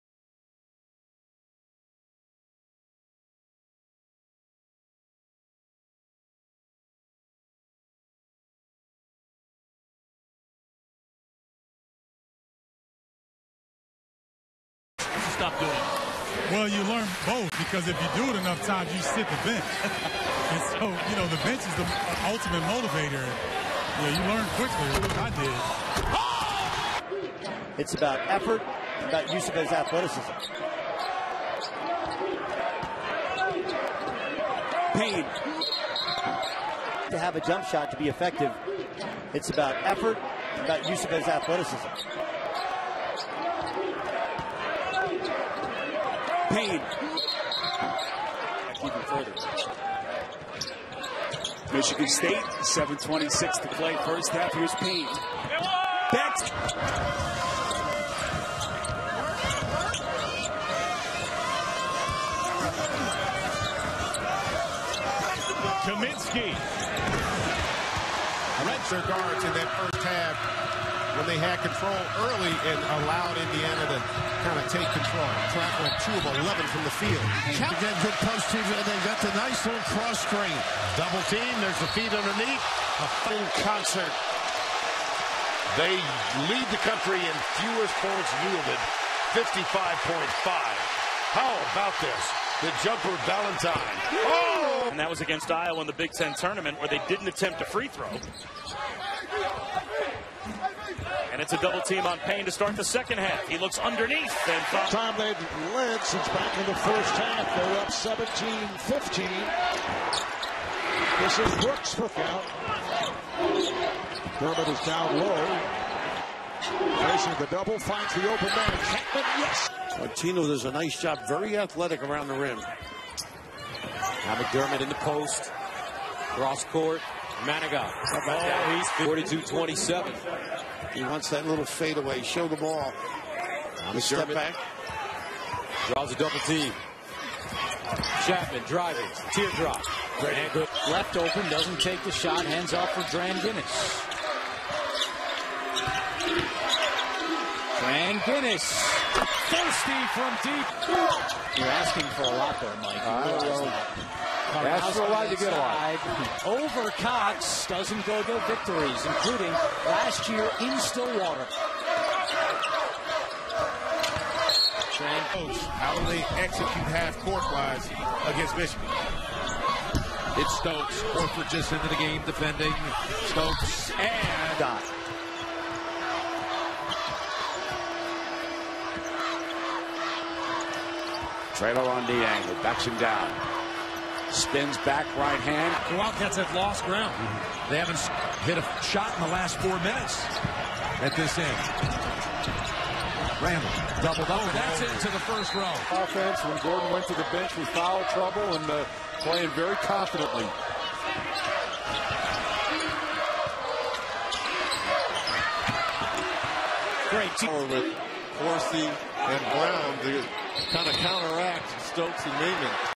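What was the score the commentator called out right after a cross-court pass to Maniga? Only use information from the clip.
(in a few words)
42-27.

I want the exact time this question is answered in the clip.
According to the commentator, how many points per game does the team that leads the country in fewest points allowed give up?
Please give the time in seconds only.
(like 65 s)
89 s.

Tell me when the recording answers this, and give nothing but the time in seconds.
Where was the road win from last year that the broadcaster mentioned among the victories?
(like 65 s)
160 s.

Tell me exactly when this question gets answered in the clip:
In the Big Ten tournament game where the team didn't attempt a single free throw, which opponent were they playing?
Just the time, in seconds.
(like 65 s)
95 s.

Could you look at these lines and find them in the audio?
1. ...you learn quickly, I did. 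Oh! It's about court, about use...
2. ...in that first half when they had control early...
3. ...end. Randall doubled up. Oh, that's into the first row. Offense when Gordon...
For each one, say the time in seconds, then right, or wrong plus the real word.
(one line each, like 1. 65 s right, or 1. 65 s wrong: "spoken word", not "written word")
1. 24 s wrong: "effort", not "court"
2. 69 s right
3. 191 s right.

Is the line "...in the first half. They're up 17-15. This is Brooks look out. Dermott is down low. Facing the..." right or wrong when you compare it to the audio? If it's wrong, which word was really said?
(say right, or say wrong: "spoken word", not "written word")
right.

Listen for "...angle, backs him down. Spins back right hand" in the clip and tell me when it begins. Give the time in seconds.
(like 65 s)
182 s.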